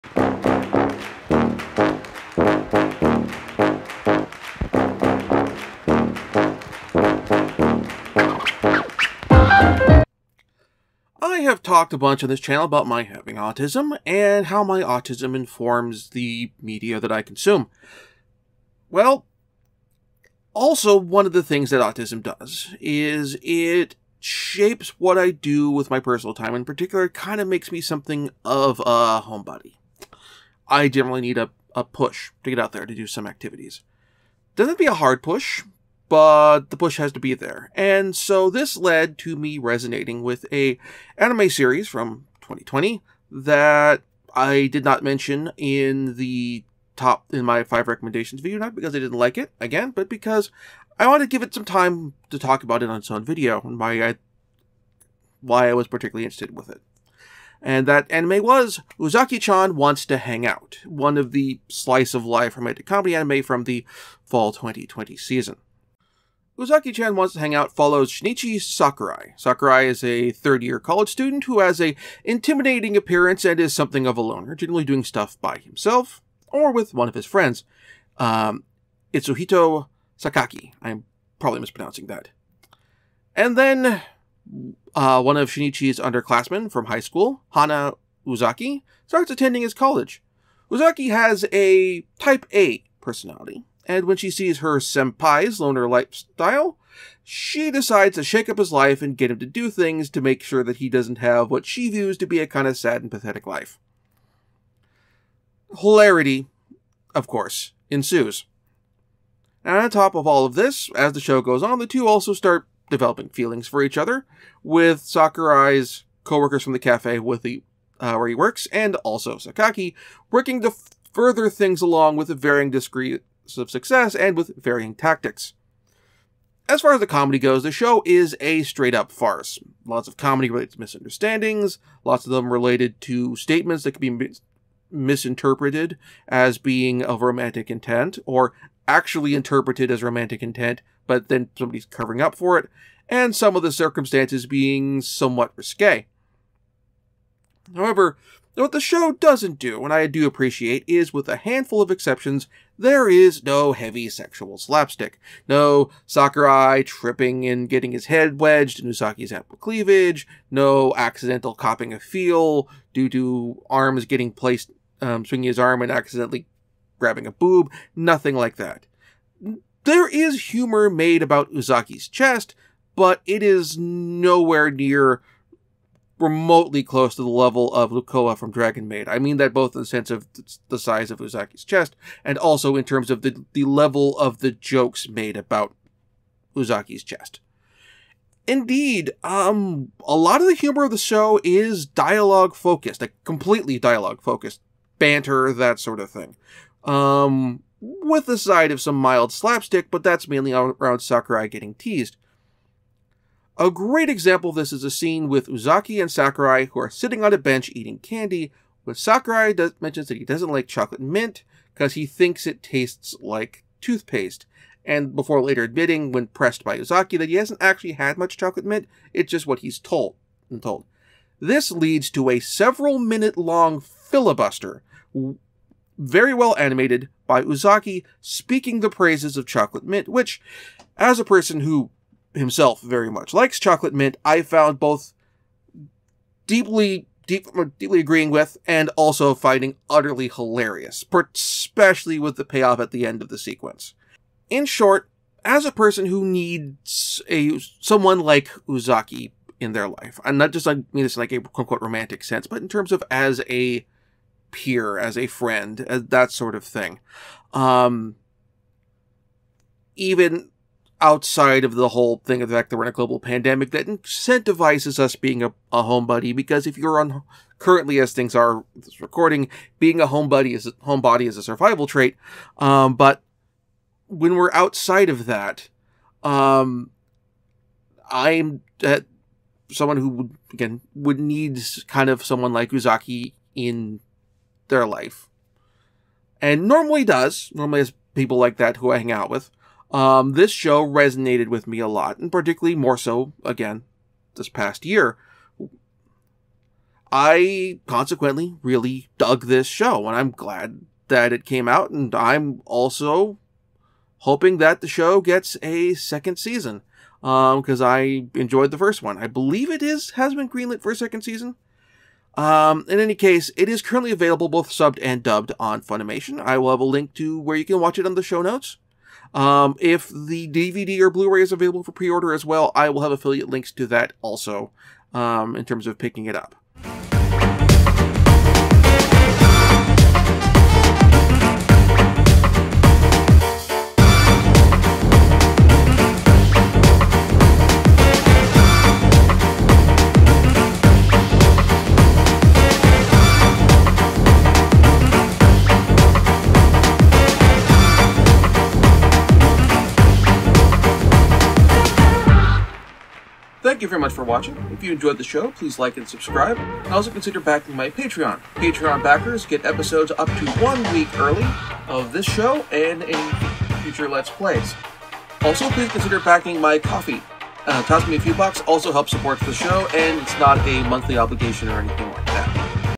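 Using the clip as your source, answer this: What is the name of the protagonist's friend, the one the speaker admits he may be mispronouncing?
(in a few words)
Itsuhito Sakaki.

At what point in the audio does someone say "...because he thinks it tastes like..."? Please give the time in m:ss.
3:31.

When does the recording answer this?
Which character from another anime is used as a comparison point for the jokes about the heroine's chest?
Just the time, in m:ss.
2:57.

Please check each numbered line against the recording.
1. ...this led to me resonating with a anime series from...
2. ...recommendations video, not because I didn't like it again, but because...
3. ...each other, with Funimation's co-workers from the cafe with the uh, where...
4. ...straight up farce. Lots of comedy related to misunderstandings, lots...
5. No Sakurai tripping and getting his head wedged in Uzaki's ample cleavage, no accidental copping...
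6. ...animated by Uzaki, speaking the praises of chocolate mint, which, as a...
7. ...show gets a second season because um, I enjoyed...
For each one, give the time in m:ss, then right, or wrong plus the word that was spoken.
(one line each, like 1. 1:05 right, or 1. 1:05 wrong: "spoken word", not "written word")
1. 0:38 right
2. 0:47 right
3. 1:53 wrong: "Sakurai", not "Funimation"
4. 2:08 right
5. 2:35 right
6. 3:46 right
7. 5:04 right.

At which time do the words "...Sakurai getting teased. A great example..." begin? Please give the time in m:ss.
3:20.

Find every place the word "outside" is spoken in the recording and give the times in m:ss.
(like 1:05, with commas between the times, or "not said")
4:21, 4:34.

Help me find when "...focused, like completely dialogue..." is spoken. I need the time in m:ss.
3:12.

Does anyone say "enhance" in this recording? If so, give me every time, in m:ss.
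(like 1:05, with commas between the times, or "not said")
not said.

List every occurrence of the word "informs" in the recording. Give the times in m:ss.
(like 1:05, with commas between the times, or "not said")
0:15.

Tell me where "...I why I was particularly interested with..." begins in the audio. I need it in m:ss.
0:54.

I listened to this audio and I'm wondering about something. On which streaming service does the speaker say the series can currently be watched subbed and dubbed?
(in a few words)
Funimation.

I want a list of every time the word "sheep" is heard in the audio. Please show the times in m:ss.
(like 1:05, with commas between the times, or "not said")
not said.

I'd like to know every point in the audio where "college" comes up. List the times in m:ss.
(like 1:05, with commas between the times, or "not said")
1:10, 1:29.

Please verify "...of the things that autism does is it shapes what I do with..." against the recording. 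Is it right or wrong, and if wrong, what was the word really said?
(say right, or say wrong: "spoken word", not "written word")
right.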